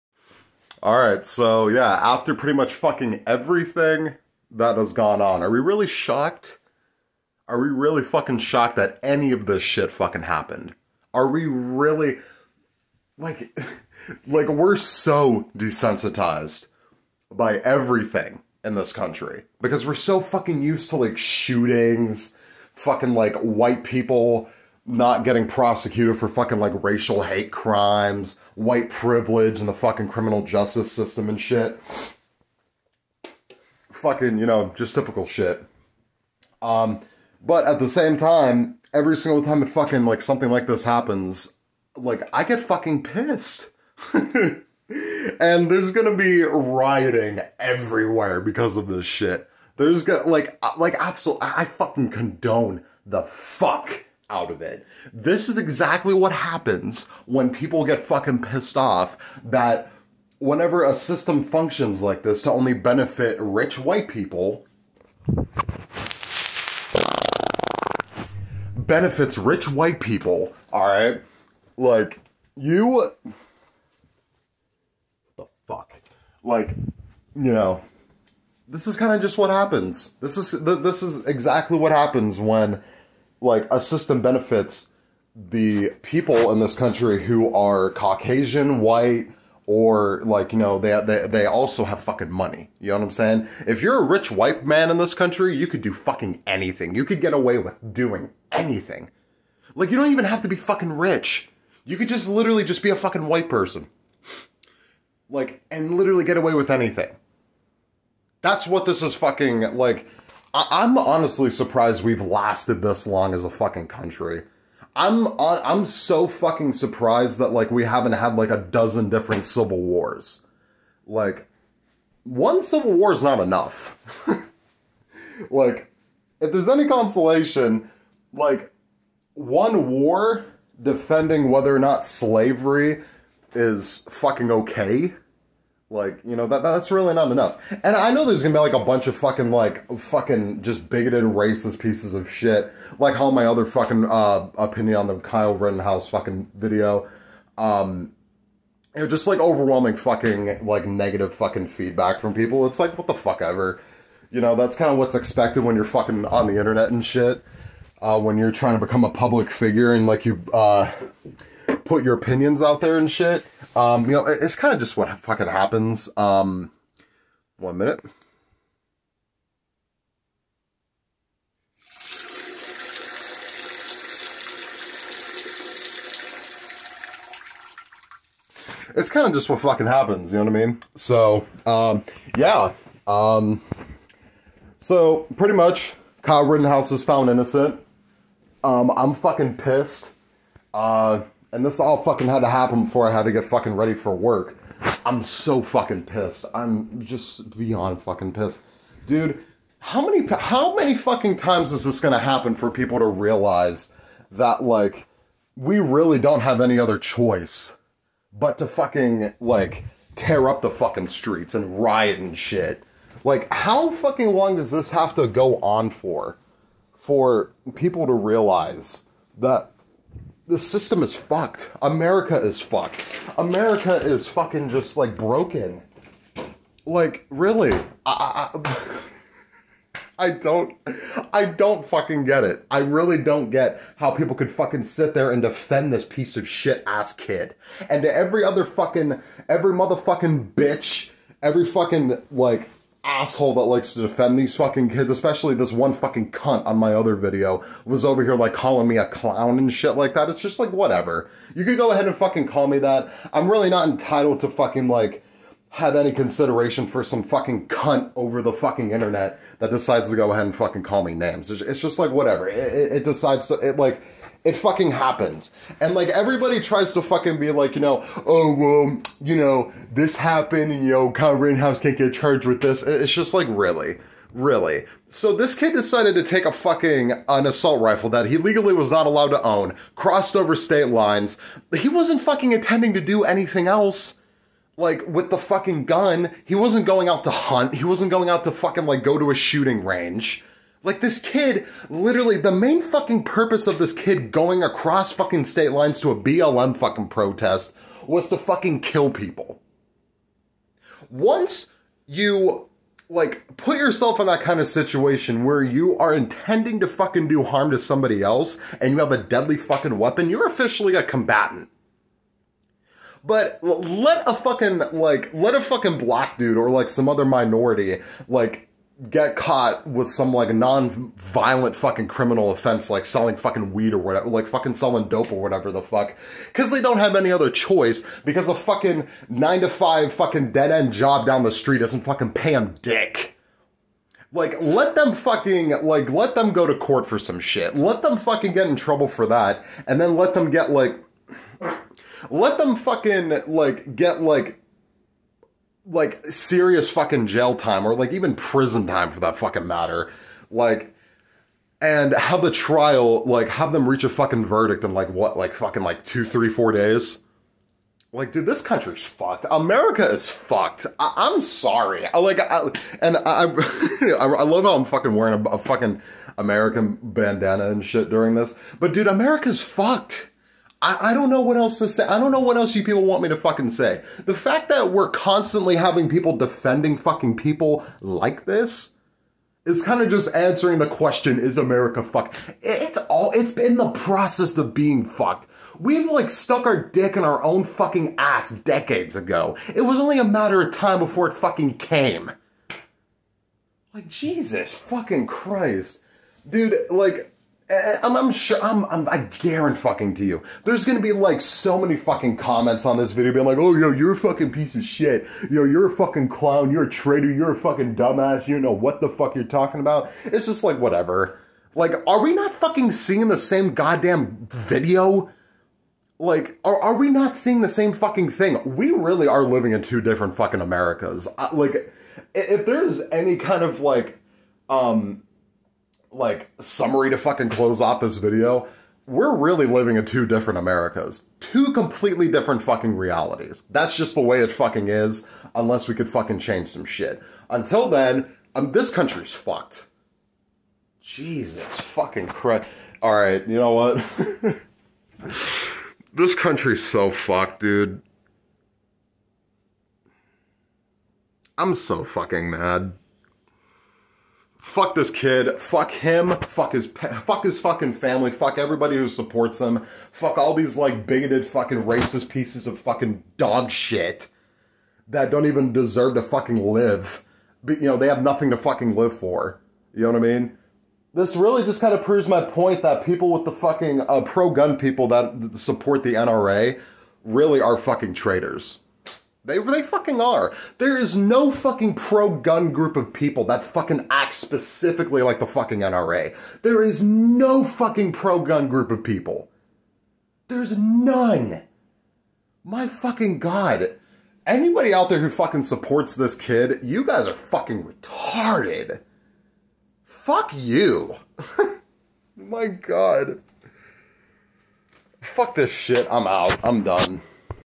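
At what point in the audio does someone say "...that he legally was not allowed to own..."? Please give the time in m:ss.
4:38.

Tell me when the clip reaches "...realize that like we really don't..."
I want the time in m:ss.
3:23.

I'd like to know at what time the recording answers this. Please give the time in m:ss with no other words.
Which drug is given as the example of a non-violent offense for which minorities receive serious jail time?
5:23.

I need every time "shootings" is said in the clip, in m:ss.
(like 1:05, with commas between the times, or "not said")
0:21, 4:49.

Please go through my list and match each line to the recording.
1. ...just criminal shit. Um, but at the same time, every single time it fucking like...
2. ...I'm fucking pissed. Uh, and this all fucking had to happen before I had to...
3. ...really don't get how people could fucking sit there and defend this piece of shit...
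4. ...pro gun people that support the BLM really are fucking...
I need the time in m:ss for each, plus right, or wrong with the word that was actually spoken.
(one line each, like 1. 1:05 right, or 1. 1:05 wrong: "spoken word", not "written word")
1. 0:34 wrong: "typical", not "criminal"
2. 3:08 right
3. 3:52 right
4. 7:54 wrong: "NRA", not "BLM".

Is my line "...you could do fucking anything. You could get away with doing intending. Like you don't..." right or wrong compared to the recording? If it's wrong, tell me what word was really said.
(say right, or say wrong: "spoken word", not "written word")
wrong: "anything", not "intending".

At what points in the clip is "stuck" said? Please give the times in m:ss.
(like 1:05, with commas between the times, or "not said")
6:26.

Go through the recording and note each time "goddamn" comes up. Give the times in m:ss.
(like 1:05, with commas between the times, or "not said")
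6:53.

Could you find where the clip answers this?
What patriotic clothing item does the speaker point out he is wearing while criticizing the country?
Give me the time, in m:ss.
6:06.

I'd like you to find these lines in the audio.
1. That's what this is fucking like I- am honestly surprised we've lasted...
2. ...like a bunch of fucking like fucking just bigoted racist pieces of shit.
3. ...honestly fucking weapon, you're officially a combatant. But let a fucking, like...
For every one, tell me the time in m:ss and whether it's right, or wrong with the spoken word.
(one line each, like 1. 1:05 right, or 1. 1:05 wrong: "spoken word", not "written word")
1. 1:48 right
2. 2:18 right
3. 5:09 wrong: "deadly", not "honestly".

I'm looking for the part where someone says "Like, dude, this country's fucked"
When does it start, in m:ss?
5:58.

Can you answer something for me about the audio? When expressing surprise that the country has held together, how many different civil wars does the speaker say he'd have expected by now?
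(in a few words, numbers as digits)
a dozen.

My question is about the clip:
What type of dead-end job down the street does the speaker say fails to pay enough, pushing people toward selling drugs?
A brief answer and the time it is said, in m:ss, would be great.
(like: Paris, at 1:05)
nine to five, at 5:29.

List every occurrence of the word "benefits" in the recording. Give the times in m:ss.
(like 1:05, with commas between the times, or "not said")
1:02, 1:08, 1:24.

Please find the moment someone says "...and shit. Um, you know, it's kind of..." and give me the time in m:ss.
2:42.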